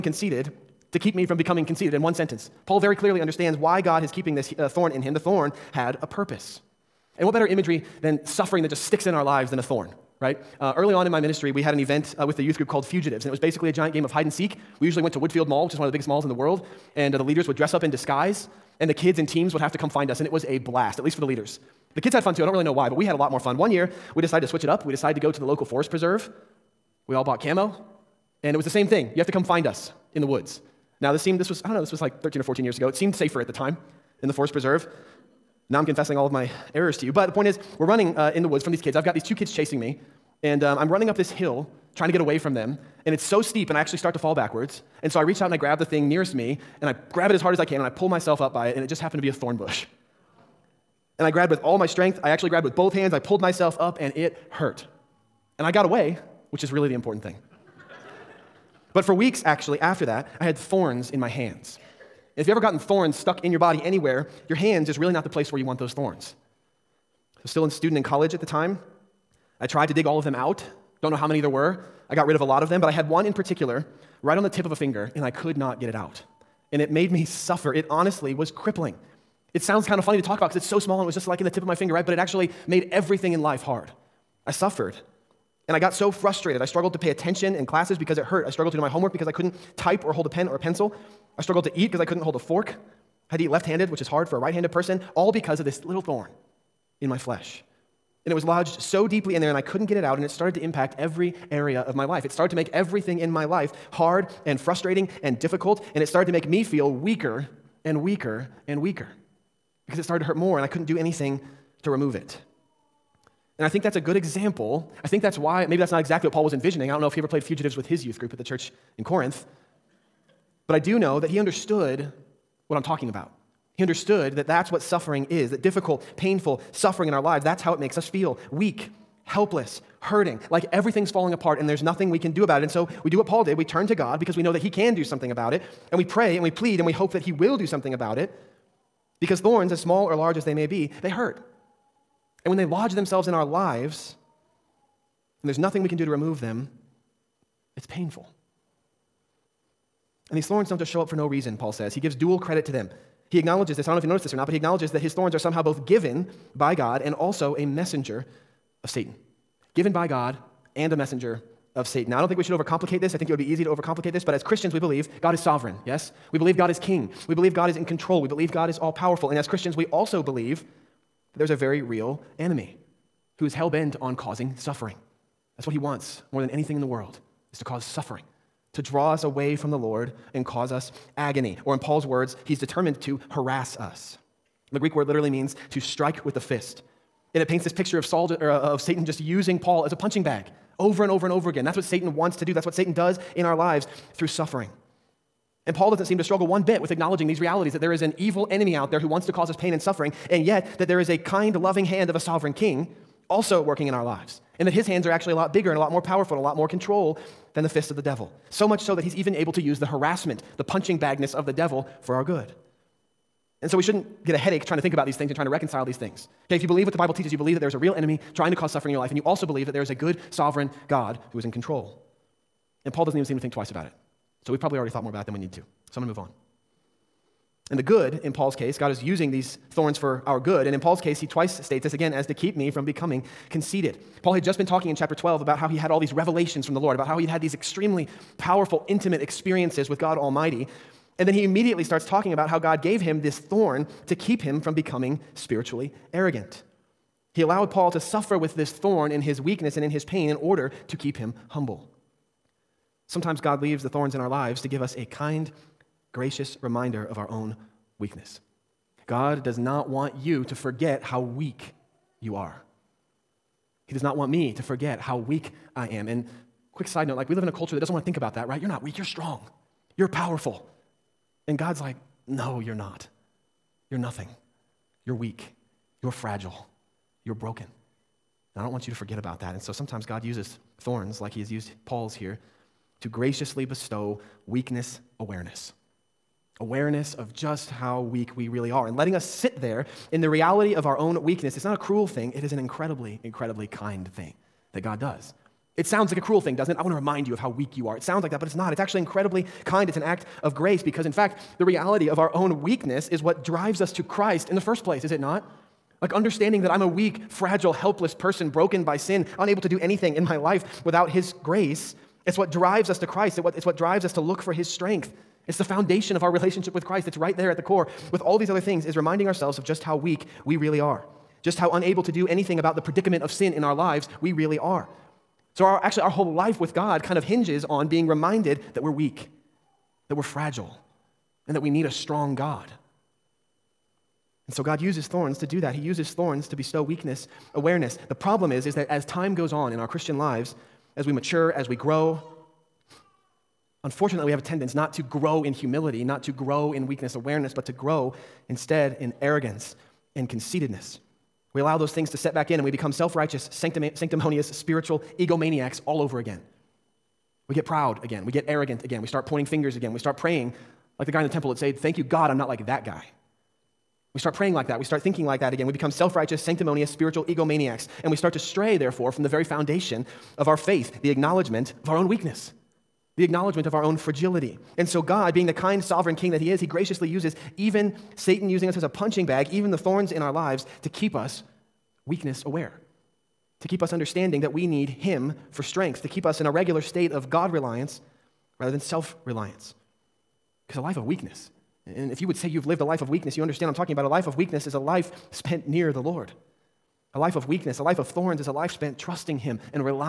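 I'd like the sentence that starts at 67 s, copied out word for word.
I was still a student in college at the time.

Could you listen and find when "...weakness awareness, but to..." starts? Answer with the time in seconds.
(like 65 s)
346 s.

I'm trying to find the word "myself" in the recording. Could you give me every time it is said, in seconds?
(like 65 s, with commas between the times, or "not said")
48 s, 53 s.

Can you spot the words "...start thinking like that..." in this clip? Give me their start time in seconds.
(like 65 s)
364 s.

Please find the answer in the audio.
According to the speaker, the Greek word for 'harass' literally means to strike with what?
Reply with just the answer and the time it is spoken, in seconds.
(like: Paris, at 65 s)
the fist, at 186 s.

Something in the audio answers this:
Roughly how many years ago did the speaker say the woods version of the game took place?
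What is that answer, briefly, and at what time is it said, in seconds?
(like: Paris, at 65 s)
13 or 14 years, at 32 s.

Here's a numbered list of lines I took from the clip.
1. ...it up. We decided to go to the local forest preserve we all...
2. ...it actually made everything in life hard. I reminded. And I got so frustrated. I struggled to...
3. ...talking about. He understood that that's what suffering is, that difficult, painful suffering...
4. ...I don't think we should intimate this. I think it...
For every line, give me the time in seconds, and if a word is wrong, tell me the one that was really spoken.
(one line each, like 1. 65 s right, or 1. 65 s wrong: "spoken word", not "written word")
1. 24 s right
2. 82 s wrong: "suffered", not "reminded"
3. 122 s right
4. 162 s wrong: "overcomplicate", not "intimate".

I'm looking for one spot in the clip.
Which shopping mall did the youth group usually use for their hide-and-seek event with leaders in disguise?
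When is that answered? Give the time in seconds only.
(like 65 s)
15 s.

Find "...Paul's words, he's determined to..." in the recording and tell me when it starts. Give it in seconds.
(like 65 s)
181 s.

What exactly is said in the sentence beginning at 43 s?
And it's so steep, and I actually start to fall backwards.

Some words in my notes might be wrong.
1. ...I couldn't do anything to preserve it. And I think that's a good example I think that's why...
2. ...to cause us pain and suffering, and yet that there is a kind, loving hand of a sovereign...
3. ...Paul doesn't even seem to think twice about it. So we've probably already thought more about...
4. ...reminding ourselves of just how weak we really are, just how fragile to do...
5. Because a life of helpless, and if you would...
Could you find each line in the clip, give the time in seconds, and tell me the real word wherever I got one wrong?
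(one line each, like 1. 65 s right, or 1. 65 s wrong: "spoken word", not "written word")
1. 110 s wrong: "remove", not "preserve"
2. 199 s right
3. 222 s right
4. 318 s wrong: "unable", not "fragile"
5. 390 s wrong: "weakness", not "helpless".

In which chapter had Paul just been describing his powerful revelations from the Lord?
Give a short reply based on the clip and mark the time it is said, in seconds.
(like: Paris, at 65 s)
chapter 12, at 234 s.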